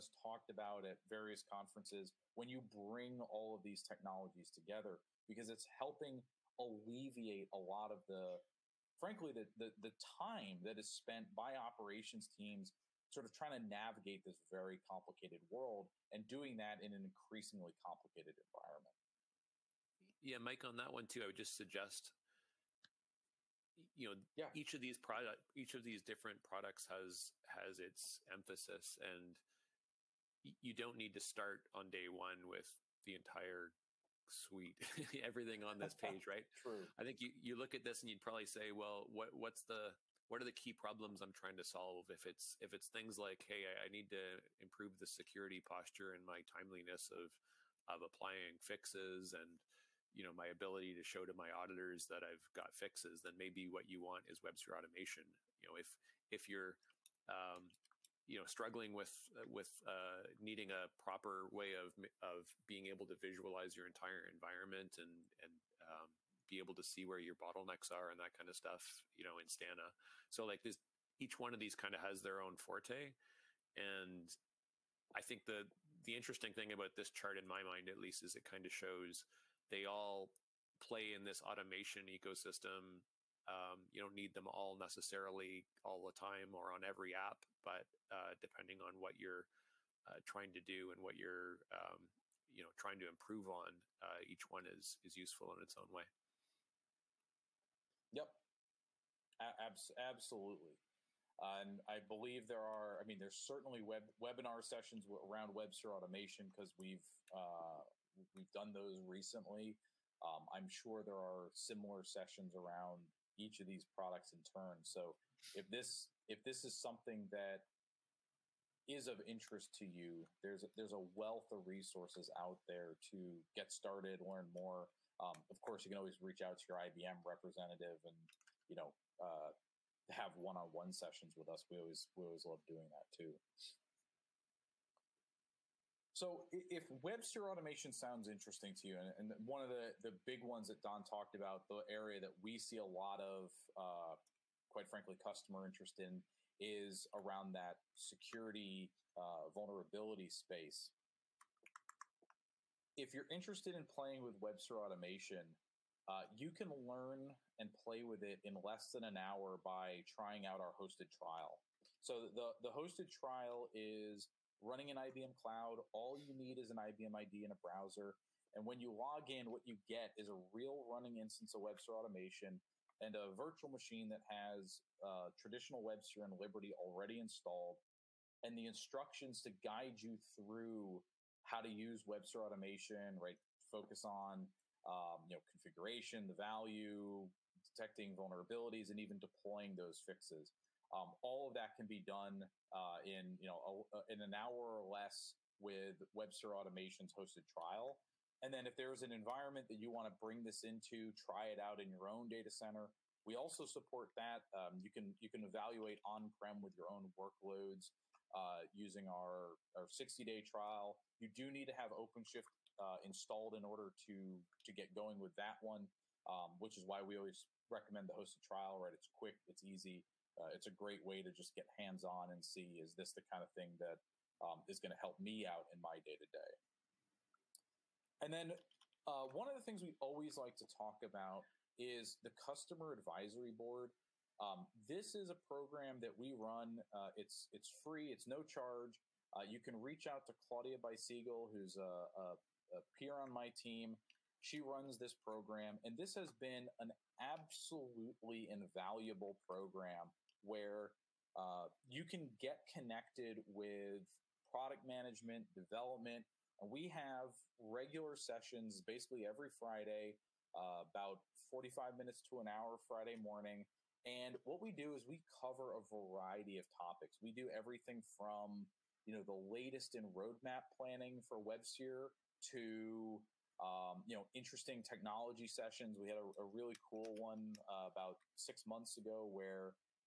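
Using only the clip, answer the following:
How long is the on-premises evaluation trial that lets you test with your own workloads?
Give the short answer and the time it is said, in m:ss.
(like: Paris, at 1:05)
60-day, at 3:29.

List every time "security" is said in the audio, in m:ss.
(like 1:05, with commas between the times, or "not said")
0:45, 2:27.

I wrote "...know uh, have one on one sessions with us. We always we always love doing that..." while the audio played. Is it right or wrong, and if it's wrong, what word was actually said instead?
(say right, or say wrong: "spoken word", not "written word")
right.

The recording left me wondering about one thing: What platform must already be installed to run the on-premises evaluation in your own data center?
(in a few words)
OpenShift.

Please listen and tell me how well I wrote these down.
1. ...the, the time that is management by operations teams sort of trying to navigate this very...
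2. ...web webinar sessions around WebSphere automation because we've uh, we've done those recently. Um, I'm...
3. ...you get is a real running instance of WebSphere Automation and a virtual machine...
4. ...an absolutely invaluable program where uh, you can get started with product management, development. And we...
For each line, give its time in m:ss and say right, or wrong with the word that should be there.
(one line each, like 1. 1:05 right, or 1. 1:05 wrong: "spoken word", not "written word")
1. 0:09 wrong: "spent", not "management"
2. 1:43 right
3. 2:49 right
4. 4:06 wrong: "connected", not "started".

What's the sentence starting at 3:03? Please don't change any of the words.
Focus on um, you know configuration, the value, detecting vulnerabilities, and even deploying those fixes.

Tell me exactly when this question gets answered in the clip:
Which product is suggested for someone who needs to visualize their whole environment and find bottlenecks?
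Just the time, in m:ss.
1:09.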